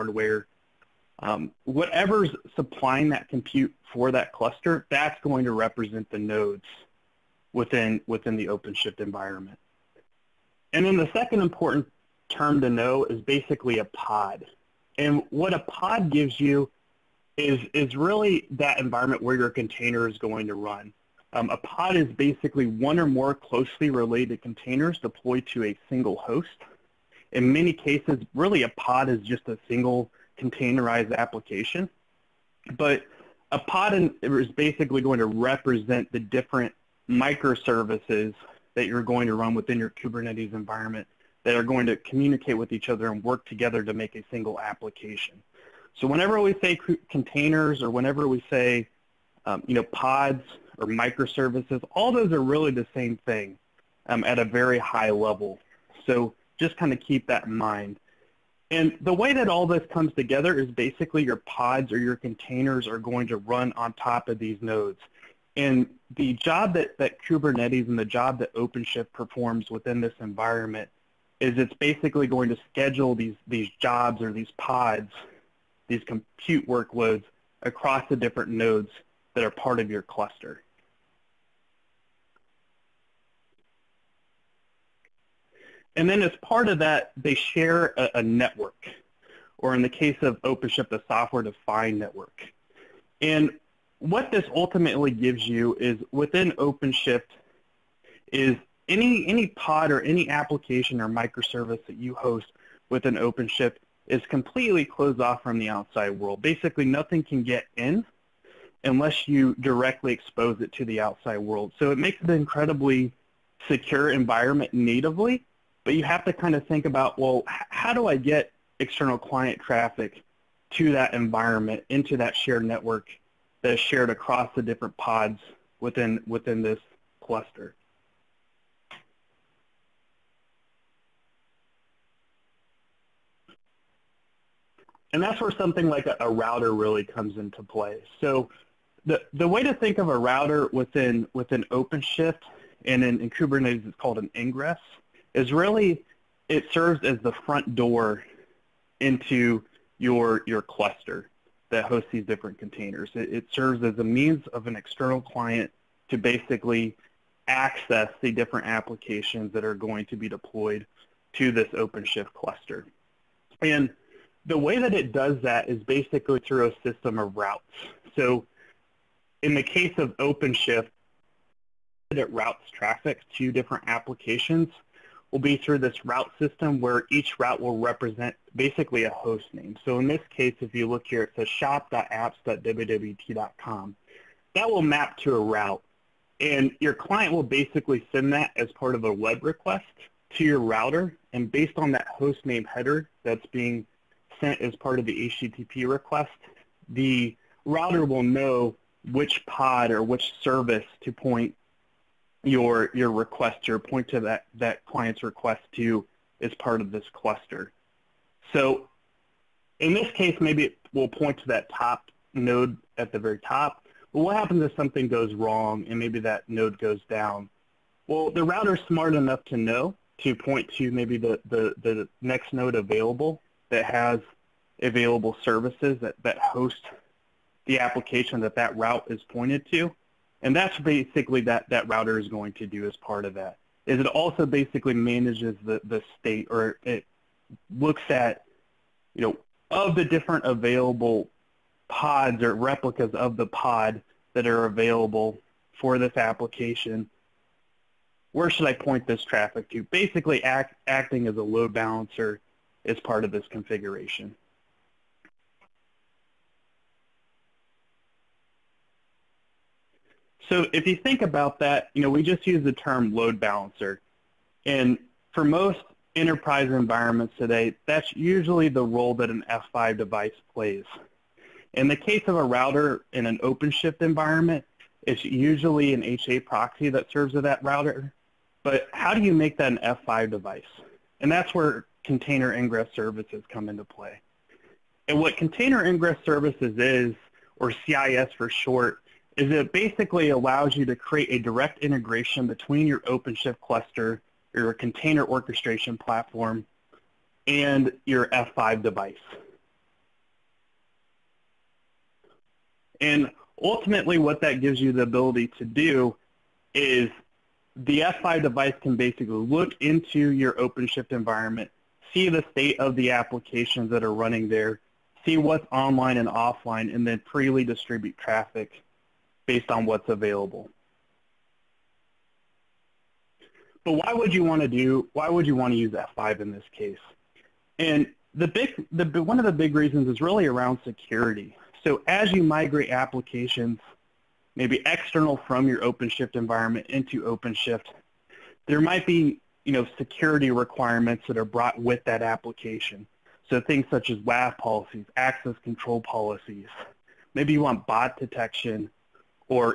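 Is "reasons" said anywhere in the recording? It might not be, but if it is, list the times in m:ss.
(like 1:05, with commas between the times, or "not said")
5:29.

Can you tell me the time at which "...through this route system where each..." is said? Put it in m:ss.
2:55.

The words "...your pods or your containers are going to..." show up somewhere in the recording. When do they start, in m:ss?
1:01.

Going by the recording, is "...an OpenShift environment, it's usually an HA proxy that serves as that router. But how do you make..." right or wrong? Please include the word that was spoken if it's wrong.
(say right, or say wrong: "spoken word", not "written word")
right.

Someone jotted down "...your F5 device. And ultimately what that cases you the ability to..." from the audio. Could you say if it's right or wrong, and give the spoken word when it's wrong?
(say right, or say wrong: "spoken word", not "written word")
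wrong: "gives", not "cases".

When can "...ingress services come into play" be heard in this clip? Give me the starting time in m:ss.
4:42.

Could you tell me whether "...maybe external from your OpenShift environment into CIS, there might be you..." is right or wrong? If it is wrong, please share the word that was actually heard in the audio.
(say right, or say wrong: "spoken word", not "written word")
wrong: "OpenShift", not "CIS".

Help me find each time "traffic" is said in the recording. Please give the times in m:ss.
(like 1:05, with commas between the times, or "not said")
1:59, 2:52, 4:09, 5:18.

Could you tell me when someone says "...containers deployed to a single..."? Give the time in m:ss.
0:24.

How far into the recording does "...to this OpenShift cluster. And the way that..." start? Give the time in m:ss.
2:41.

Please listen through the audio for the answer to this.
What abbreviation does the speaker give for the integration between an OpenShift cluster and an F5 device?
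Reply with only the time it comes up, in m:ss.
4:47.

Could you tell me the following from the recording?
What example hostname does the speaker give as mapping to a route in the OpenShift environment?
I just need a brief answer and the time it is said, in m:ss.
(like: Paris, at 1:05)
shop.apps.wwt.com, at 3:01.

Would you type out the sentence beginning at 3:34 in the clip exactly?
But what happens if something goes wrong and maybe that node goes down?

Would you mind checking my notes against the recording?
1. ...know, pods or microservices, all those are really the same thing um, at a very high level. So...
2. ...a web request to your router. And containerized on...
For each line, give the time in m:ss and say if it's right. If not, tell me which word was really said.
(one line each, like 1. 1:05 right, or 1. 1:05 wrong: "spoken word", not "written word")
1. 0:49 right
2. 3:09 wrong: "based", not "containerized".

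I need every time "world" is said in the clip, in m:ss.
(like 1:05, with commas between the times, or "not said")
1:46, 1:51.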